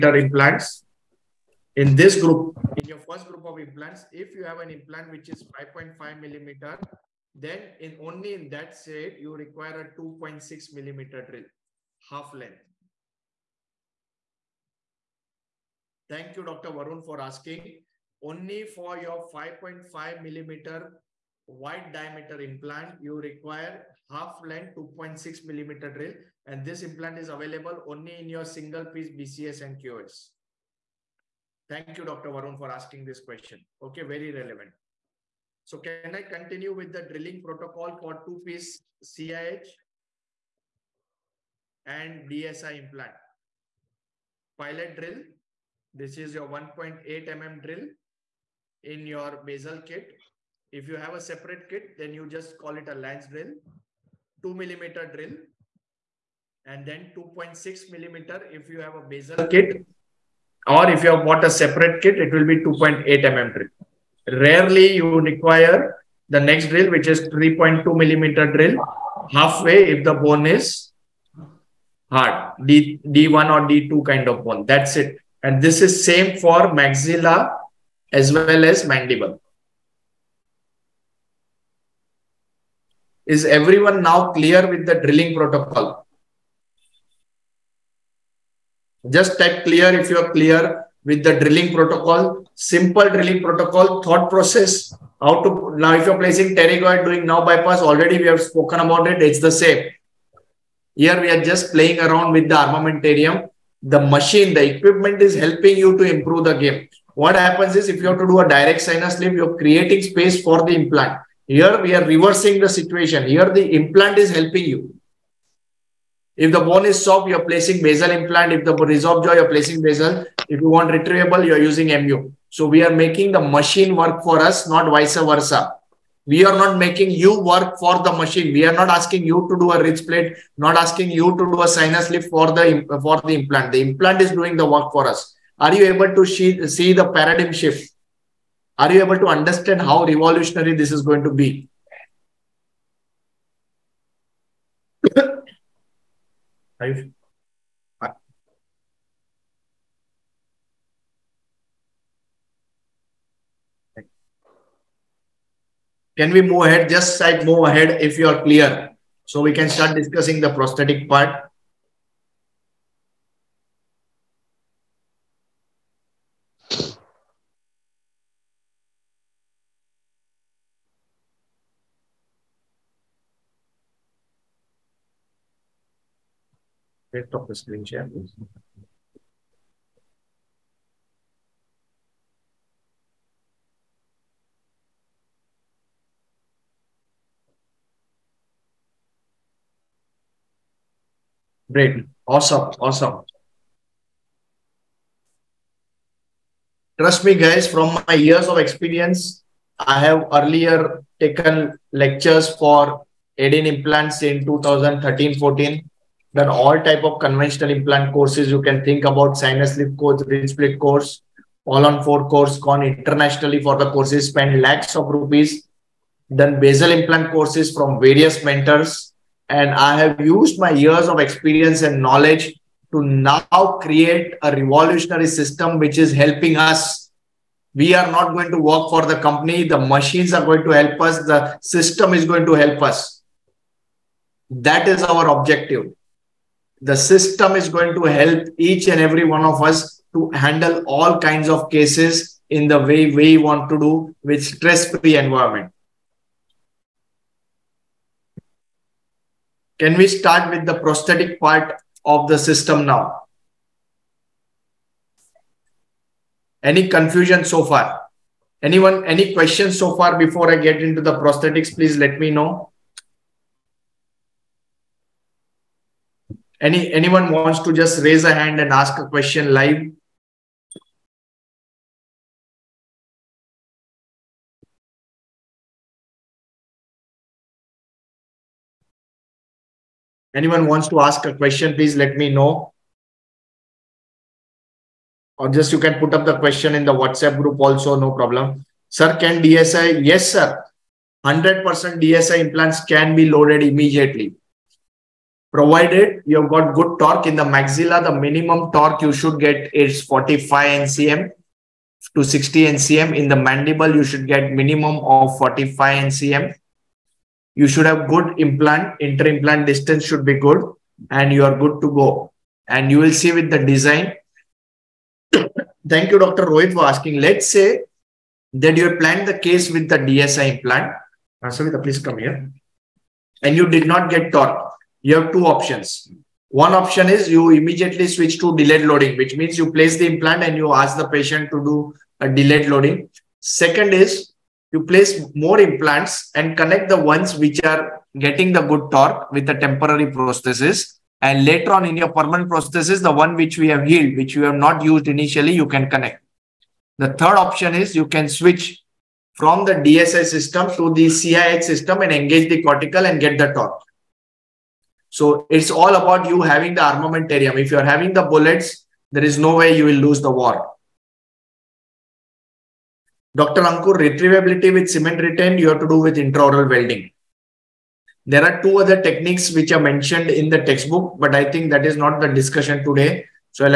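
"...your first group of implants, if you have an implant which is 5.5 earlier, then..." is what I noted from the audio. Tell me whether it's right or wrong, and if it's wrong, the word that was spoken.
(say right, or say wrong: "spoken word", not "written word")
wrong: "millimeter", not "earlier".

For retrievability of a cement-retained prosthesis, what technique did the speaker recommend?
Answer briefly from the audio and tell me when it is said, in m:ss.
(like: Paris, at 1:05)
intraoral welding, at 6:06.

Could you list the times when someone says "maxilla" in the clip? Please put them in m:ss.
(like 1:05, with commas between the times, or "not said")
1:16, 4:57.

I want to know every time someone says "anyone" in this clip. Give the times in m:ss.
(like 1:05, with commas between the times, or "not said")
4:18, 4:26, 4:40.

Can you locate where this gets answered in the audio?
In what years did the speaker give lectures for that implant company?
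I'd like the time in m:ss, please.
3:24.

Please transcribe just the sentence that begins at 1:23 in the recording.
Is everyone now clear with the drilling protocol?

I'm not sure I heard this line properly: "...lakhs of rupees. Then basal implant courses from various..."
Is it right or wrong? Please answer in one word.
right.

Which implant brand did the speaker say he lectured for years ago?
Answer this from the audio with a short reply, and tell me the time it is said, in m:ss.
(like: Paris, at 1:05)
Adin, at 3:23.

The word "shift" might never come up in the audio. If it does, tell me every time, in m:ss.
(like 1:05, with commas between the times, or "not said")
2:17.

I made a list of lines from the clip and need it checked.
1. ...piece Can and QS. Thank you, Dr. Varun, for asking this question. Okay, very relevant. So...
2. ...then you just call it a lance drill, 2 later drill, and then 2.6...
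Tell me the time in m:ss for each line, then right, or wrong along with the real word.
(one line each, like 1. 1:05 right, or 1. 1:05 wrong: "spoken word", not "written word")
1. 0:28 wrong: "BCS", not "Can"
2. 0:51 wrong: "millimeter", not "later".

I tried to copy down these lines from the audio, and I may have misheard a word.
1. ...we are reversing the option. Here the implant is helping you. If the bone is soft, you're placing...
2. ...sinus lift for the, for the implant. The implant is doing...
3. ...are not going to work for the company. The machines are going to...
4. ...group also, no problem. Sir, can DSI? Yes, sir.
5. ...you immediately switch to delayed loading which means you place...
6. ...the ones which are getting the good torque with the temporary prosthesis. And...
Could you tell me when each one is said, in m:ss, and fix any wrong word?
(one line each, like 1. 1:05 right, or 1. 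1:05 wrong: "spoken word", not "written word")
1. 1:51 wrong: "situation", not "option"
2. 2:11 right
3. 3:47 right
4. 4:47 right
5. 5:27 right
6. 5:36 right.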